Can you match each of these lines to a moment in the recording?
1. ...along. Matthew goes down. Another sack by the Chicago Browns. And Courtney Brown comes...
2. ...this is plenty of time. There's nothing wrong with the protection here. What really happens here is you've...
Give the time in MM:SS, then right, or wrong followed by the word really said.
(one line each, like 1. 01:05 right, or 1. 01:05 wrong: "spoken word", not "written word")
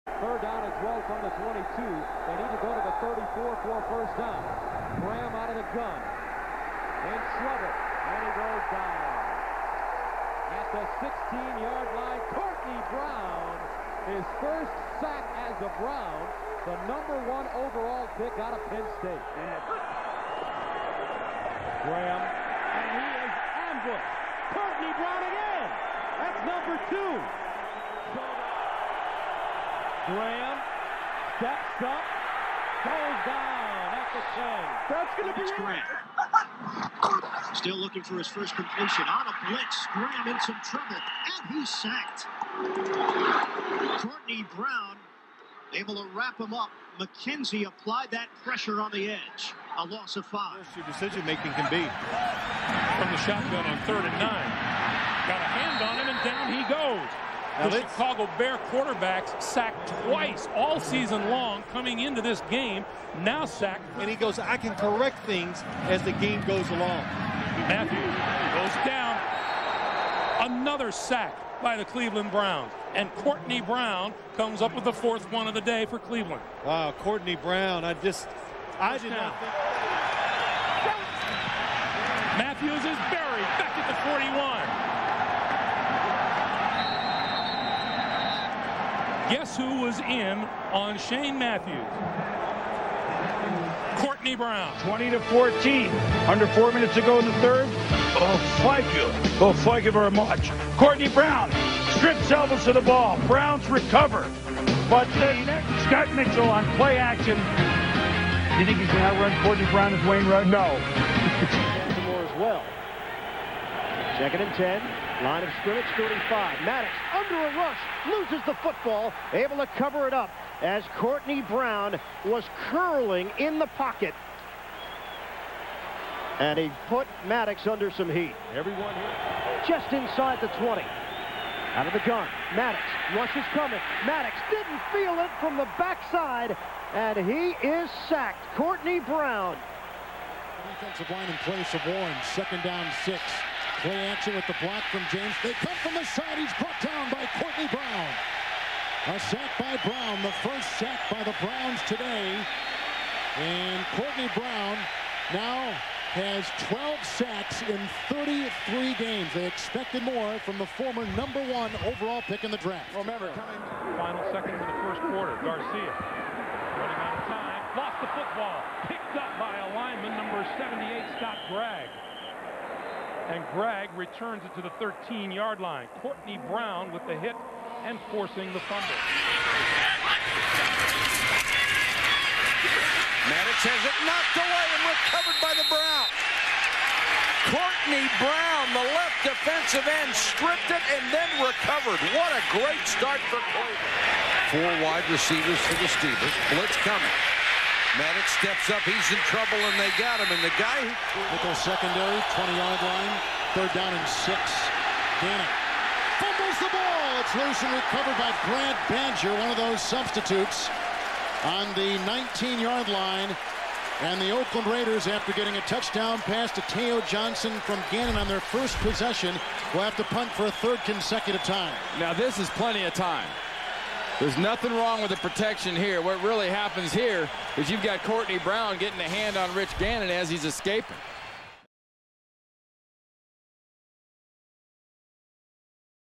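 1. 01:06 wrong: "Cleveland", not "Chicago"
2. 03:42 right.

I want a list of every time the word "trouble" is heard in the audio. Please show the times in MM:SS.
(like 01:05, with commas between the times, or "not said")
00:40, 03:19.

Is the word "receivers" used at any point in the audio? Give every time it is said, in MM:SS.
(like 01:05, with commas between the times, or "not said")
03:15.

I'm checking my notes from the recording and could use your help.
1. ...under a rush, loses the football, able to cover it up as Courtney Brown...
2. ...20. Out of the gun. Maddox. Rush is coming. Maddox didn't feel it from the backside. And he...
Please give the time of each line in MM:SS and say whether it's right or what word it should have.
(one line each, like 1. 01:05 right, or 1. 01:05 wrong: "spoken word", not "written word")
1. 01:57 right
2. 02:10 right.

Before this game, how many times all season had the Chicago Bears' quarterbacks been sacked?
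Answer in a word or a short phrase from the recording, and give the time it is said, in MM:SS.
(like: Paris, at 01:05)
2, at 01:00.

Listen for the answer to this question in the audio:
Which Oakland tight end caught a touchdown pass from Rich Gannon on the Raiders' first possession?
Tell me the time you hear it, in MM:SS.
03:36.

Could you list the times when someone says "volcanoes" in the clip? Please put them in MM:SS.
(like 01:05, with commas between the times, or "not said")
not said.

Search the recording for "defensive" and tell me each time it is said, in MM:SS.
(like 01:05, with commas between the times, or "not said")
02:20, 03:09.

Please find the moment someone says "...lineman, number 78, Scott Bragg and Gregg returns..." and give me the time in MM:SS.
02:49.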